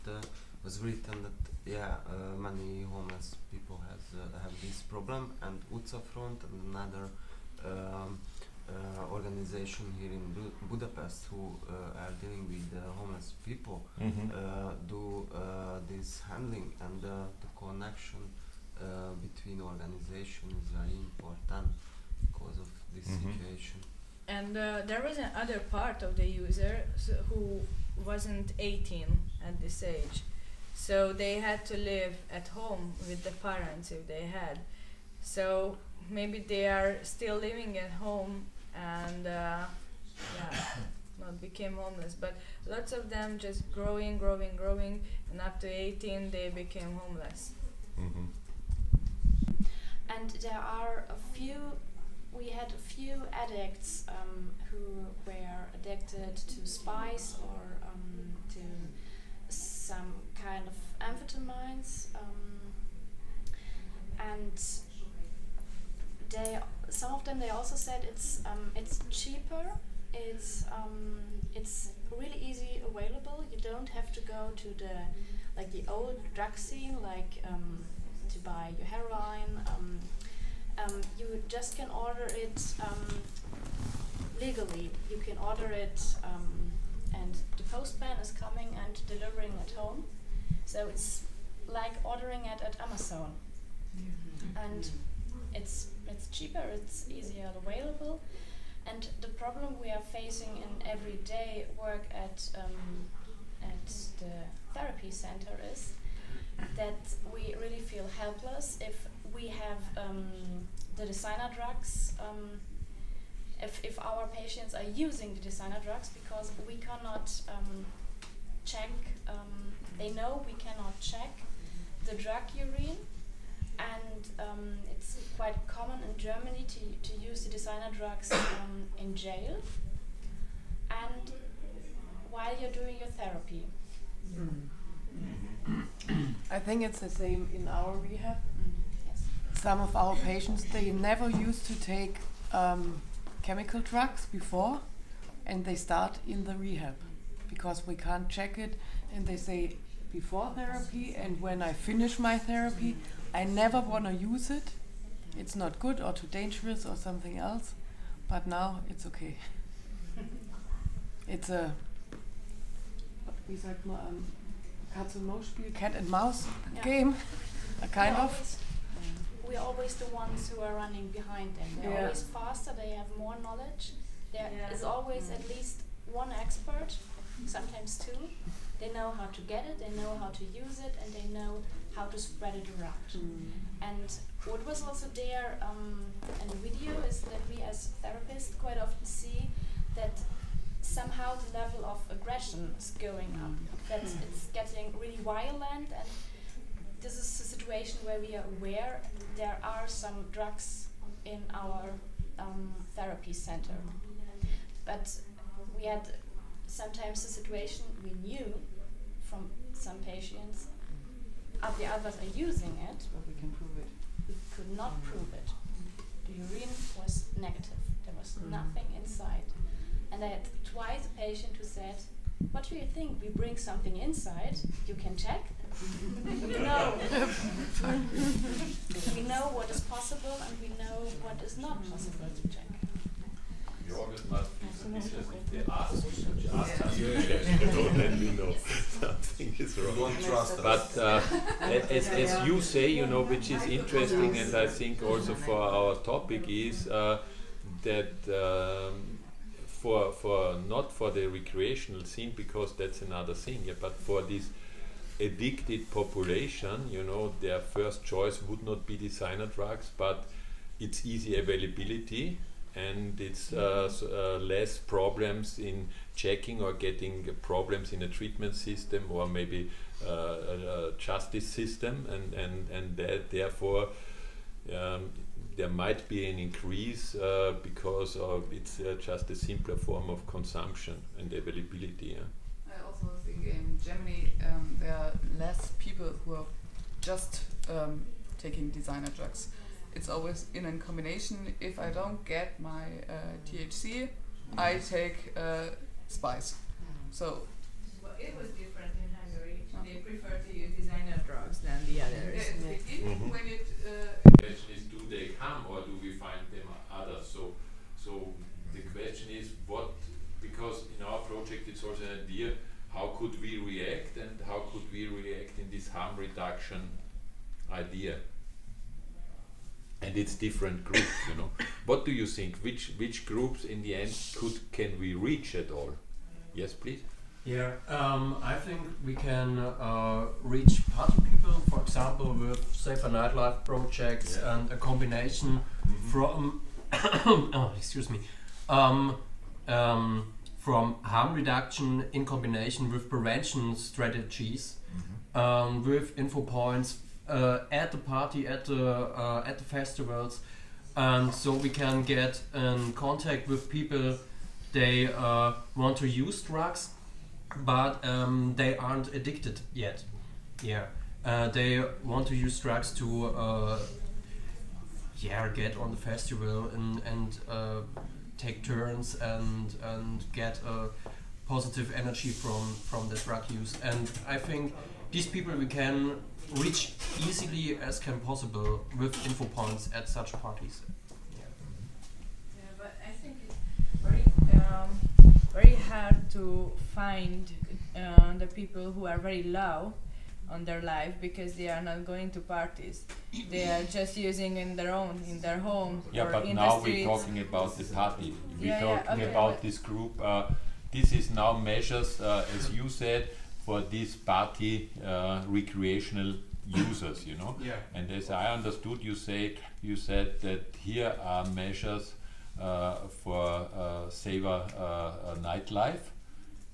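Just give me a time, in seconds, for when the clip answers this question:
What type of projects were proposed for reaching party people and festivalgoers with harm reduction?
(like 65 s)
332 s.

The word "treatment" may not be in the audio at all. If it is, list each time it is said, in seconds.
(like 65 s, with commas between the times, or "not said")
268 s.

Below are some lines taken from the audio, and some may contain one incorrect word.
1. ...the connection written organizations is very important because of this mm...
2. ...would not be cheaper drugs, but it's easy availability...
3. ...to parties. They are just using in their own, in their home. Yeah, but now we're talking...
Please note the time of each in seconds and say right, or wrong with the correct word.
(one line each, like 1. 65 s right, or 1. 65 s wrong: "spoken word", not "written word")
1. 17 s wrong: "between", not "written"
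2. 258 s wrong: "designer", not "cheaper"
3. 392 s right.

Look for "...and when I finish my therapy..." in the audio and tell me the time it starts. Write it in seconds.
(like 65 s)
151 s.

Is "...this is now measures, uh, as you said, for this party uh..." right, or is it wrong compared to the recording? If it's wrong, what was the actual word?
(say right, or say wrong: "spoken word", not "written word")
right.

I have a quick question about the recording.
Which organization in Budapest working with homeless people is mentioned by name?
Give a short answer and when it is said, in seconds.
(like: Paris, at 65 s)
Utcafront, at 5 s.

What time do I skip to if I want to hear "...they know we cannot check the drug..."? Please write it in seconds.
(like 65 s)
119 s.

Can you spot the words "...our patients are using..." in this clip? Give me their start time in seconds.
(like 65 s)
113 s.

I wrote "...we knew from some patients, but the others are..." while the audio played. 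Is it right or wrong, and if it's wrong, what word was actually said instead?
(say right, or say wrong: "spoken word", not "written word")
right.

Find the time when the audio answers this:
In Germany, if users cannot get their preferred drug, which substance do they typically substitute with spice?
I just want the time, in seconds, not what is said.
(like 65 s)
293 s.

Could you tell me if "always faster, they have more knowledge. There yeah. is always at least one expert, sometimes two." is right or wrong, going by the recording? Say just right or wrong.
right.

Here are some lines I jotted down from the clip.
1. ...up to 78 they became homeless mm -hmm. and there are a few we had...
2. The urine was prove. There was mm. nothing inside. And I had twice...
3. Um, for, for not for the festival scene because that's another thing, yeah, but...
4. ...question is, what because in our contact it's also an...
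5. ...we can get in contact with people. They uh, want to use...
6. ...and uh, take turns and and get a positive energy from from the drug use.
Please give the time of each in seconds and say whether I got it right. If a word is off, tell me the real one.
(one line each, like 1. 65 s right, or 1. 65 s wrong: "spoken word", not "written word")
1. 45 s wrong: "18", not "78"
2. 216 s wrong: "negative", not "prove"
3. 248 s wrong: "recreational", not "festival"
4. 308 s wrong: "project", not "contact"
5. 351 s right
6. 367 s right.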